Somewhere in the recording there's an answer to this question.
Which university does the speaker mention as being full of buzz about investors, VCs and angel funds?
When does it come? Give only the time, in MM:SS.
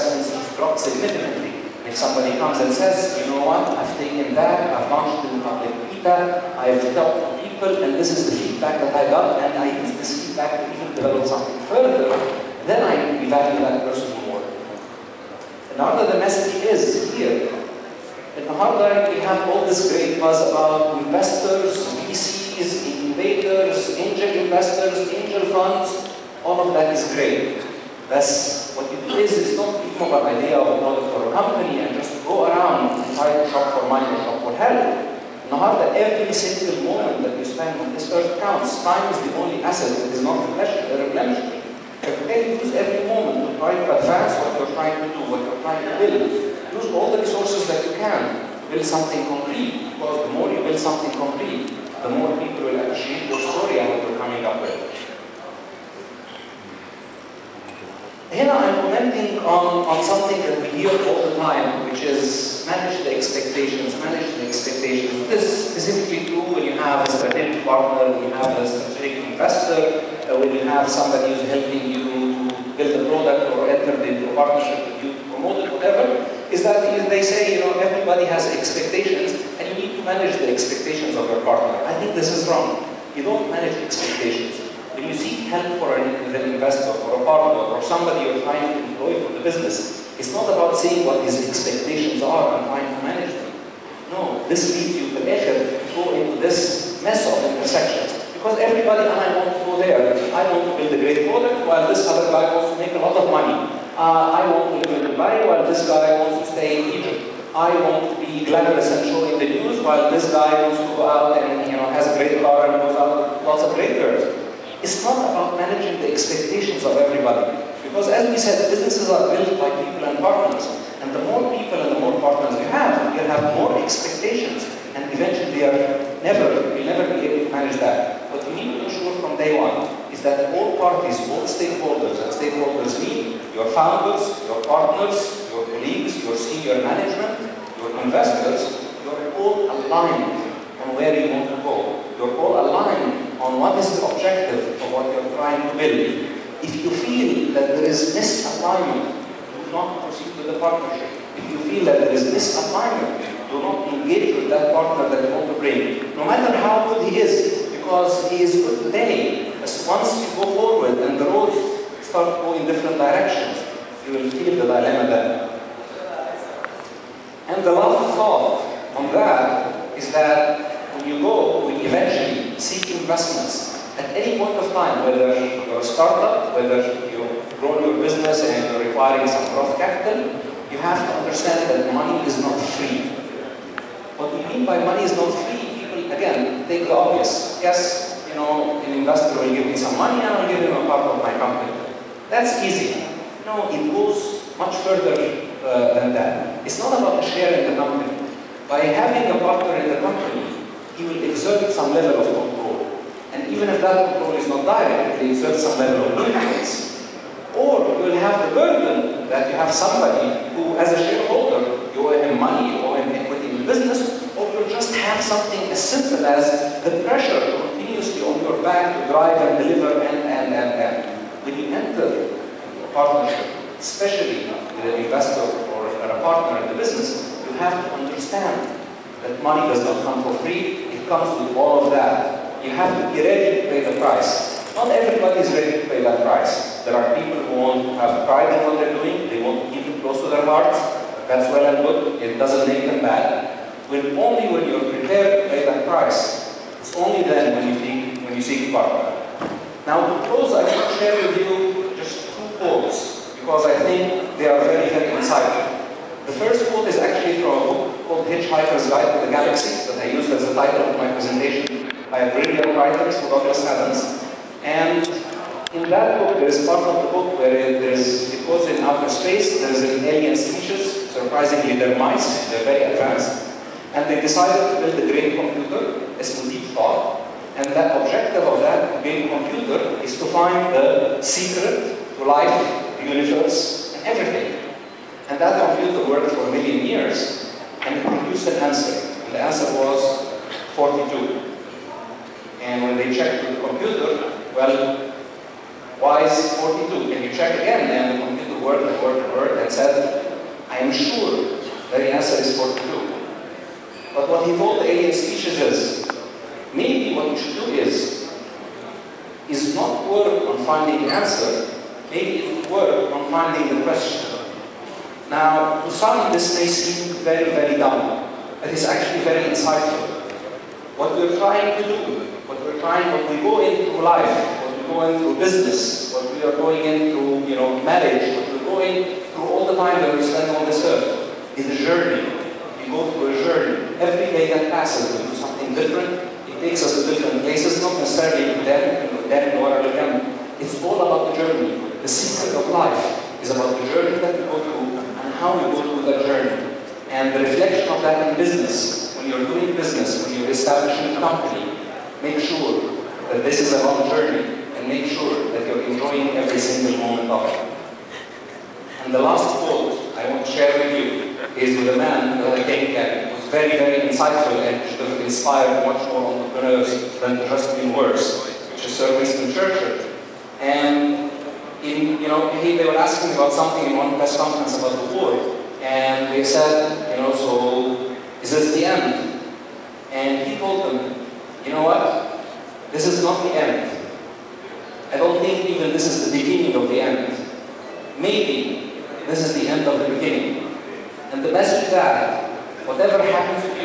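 00:18.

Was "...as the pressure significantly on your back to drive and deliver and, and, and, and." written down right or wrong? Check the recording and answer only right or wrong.
wrong.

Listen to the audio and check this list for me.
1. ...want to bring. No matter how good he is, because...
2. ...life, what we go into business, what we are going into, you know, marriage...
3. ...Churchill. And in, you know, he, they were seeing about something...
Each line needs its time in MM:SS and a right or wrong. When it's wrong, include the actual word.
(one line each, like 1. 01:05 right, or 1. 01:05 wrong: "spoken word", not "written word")
1. 02:35 right
2. 05:24 right
3. 06:09 wrong: "asking", not "seeing".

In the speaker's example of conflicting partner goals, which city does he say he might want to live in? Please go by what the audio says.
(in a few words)
Dubai.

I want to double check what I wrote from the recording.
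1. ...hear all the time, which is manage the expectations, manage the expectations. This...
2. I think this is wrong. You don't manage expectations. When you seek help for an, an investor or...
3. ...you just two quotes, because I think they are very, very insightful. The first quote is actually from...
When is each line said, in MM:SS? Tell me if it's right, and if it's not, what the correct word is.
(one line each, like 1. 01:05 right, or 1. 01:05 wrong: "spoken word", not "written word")
1. 01:00 right
2. 01:21 right
3. 04:11 right.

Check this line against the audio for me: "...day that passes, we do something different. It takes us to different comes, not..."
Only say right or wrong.
wrong.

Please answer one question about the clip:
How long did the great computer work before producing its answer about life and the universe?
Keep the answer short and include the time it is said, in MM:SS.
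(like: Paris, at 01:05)
A million years, at 04:46.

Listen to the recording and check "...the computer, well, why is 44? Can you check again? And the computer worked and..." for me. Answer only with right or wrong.
wrong.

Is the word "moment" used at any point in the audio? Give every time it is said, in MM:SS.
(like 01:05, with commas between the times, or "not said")
00:36, 00:43, 05:57.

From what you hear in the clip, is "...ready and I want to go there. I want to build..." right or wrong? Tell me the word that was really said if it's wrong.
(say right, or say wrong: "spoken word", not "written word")
wrong: "everybody", not "ready".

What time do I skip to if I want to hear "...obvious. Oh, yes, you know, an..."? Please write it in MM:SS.
03:06.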